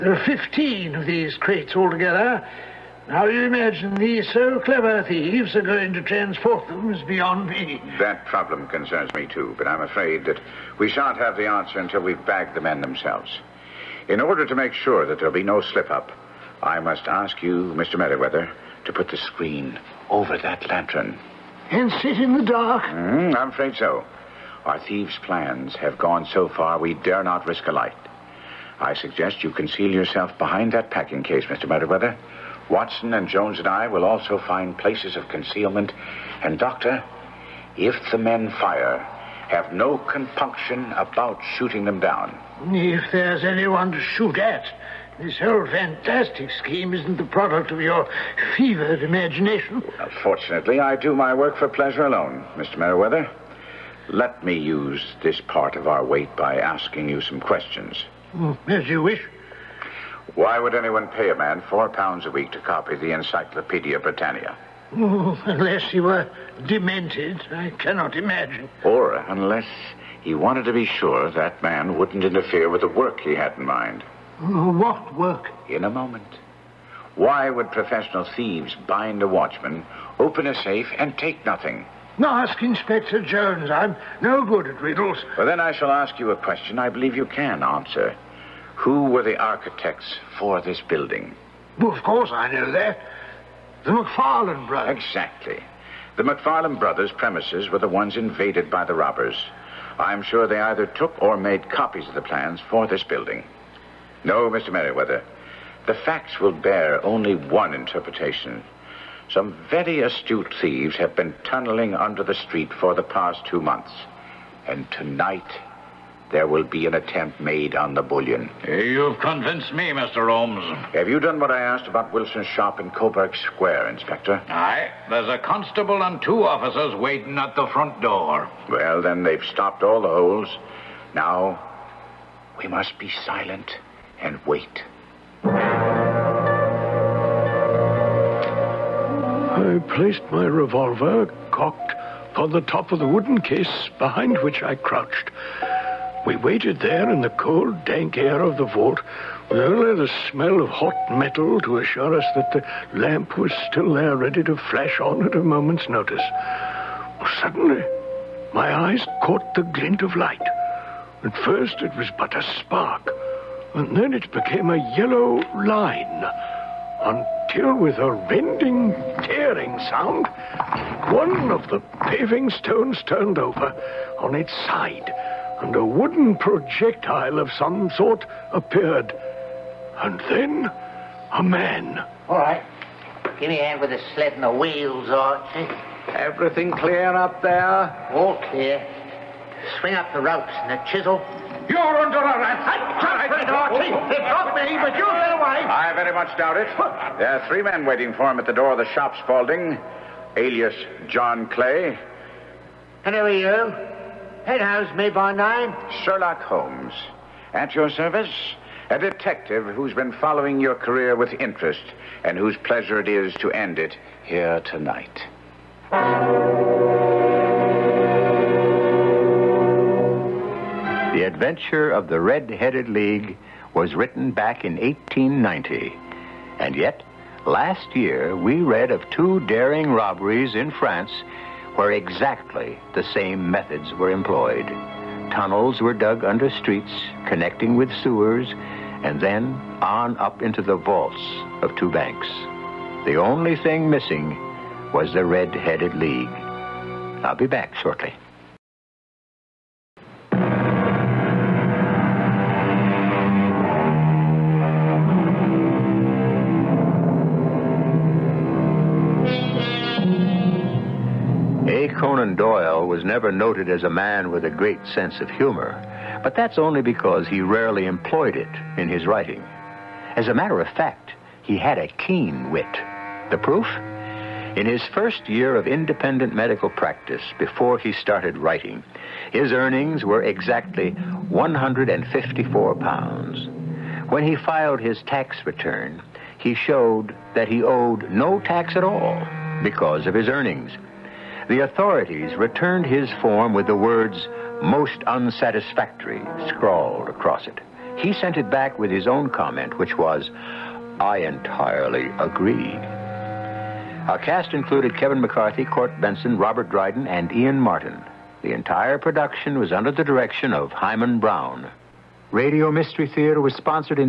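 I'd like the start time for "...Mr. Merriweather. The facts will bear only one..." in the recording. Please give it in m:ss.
1:44.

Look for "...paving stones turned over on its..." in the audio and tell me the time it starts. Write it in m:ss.
2:52.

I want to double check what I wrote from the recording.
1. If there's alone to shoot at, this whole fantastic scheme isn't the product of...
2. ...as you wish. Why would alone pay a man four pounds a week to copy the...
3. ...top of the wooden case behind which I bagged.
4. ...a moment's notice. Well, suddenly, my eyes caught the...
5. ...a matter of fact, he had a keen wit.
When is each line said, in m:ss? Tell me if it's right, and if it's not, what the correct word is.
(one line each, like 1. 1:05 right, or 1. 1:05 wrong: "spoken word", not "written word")
1. 0:42 wrong: "anyone", not "alone"
2. 0:58 wrong: "anyone", not "alone"
3. 2:22 wrong: "crouched", not "bagged"
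4. 2:35 right
5. 4:30 right.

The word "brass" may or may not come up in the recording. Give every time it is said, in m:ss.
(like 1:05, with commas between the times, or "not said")
not said.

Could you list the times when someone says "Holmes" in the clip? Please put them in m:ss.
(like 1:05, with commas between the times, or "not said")
2:00, 3:26.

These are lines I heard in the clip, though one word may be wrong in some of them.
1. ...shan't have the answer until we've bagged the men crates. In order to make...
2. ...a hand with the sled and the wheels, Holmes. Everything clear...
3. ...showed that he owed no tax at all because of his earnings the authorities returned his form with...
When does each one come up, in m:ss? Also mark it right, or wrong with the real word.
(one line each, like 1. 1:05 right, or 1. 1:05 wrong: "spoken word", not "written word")
1. 0:10 wrong: "themselves", not "crates"
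2. 3:03 wrong: "Archie", not "Holmes"
3. 4:46 right.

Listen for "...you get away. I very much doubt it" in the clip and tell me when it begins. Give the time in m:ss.
3:14.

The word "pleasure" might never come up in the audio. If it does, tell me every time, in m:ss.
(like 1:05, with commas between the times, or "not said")
0:51, 3:32.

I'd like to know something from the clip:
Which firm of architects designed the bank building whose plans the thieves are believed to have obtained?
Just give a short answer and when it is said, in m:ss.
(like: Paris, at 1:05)
The McFarland brothers, at 1:33.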